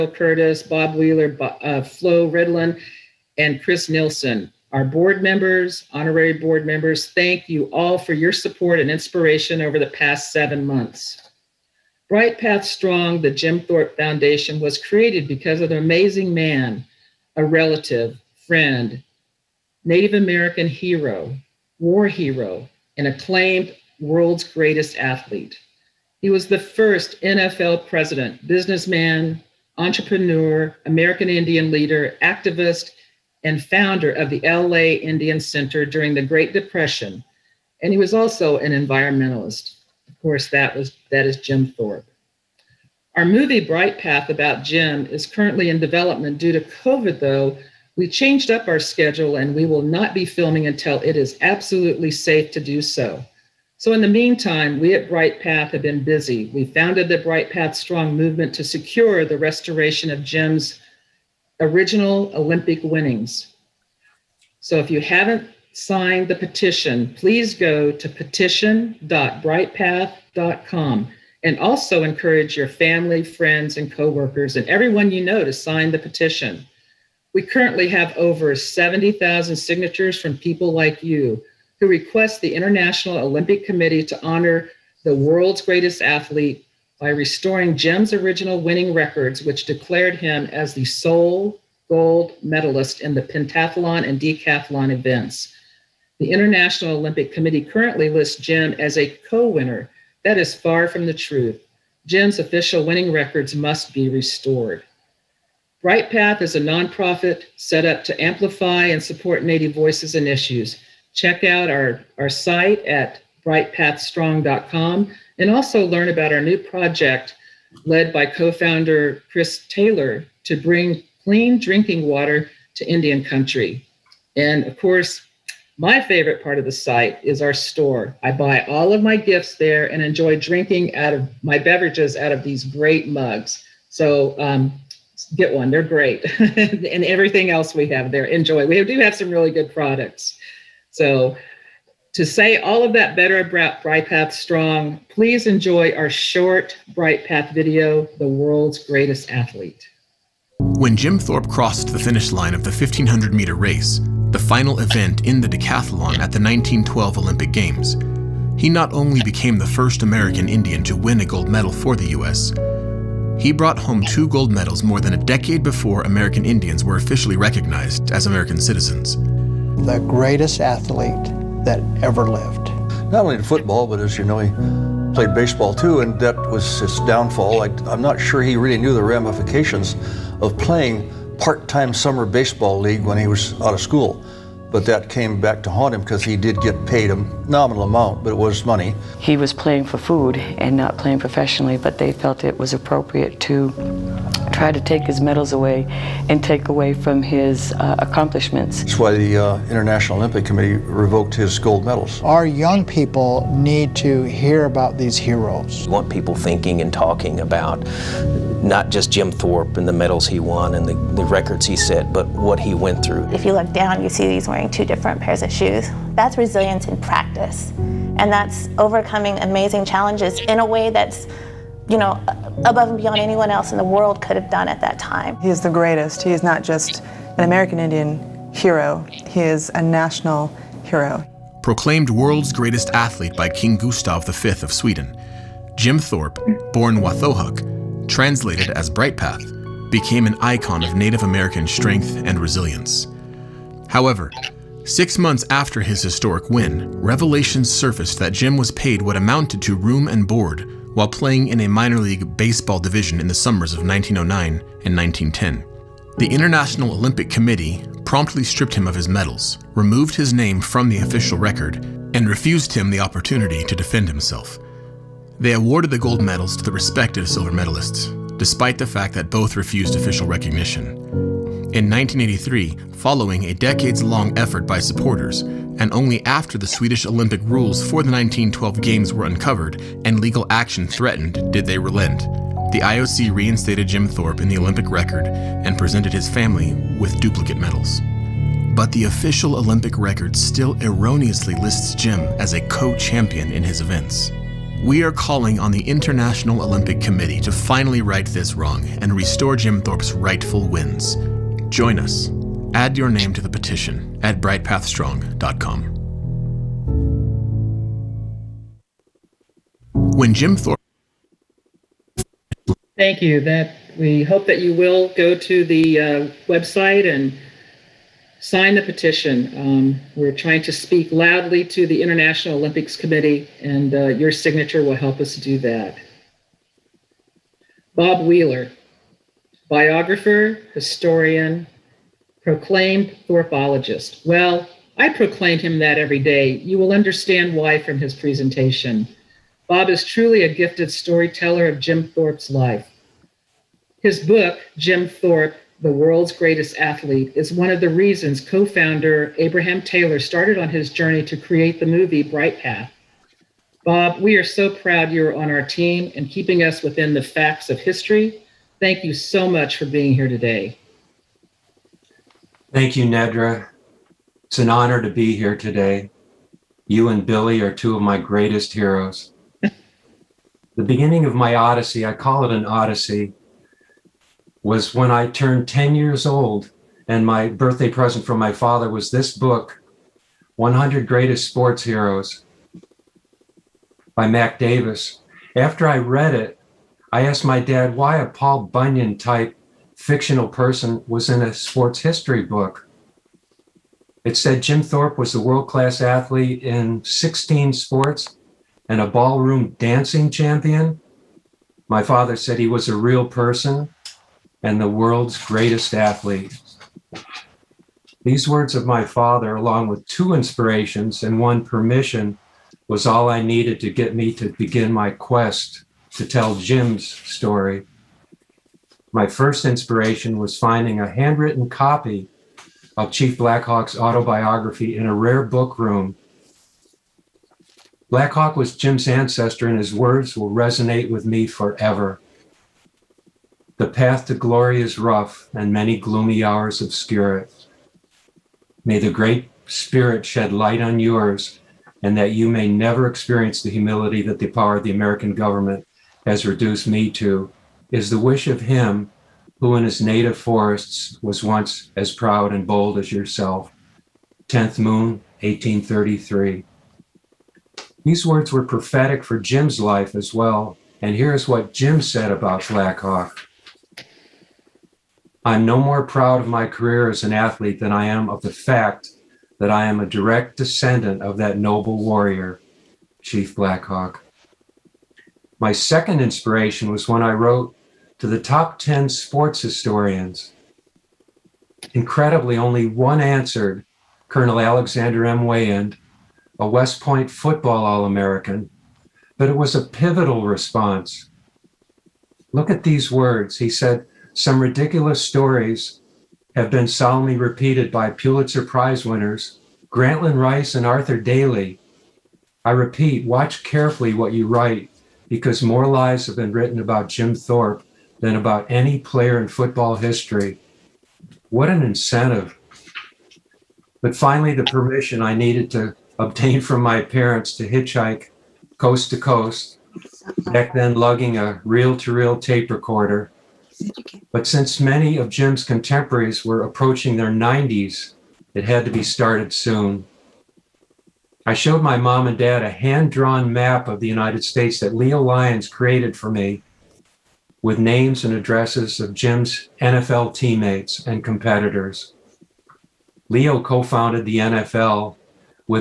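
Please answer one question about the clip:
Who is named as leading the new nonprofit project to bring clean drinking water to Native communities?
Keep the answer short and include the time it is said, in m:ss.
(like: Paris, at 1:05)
Chris Taylor, at 1:59.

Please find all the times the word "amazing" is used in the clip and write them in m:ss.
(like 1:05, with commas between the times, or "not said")
0:15, 3:39.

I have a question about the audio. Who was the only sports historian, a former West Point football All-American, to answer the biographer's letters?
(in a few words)
Alexander M. Weyand.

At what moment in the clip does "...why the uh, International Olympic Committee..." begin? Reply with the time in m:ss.
3:18.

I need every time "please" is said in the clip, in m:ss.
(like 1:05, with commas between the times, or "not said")
1:07, 2:25.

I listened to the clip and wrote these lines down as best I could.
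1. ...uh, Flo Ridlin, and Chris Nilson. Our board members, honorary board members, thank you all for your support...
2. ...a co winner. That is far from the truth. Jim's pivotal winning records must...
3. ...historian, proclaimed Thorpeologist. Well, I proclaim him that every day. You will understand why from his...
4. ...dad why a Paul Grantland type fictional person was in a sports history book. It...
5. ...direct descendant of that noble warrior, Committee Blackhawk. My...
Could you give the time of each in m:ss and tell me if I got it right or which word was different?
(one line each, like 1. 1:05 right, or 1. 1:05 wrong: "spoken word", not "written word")
1. 0:01 right
2. 1:38 wrong: "official", not "pivotal"
3. 5:30 right
4. 6:27 wrong: "Bunyan", not "Grantland"
5. 7:50 wrong: "Chief", not "Committee".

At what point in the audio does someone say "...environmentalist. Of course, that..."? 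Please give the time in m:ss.
0:38.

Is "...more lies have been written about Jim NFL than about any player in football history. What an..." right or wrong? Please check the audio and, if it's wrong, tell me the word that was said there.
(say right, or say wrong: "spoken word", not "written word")
wrong: "Thorpe", not "NFL".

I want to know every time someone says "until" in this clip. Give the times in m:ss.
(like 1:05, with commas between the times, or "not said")
0:50.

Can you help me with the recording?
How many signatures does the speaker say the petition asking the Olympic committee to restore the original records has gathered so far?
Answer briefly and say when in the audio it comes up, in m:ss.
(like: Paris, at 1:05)
over 70,000, at 1:18.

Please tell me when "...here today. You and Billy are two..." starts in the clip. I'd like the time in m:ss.
6:05.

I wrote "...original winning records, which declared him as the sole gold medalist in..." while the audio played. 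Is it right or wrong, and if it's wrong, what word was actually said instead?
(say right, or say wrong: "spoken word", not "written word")
right.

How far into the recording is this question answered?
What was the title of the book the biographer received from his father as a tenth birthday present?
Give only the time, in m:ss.
6:20.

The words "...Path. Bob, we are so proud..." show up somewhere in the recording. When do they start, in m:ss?
5:52.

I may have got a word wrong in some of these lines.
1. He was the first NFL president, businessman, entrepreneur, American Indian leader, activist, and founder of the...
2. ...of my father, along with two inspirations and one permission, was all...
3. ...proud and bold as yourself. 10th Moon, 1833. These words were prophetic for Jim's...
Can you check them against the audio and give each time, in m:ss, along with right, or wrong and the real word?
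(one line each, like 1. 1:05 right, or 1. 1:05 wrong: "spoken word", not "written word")
1. 0:26 right
2. 6:48 right
3. 7:32 right.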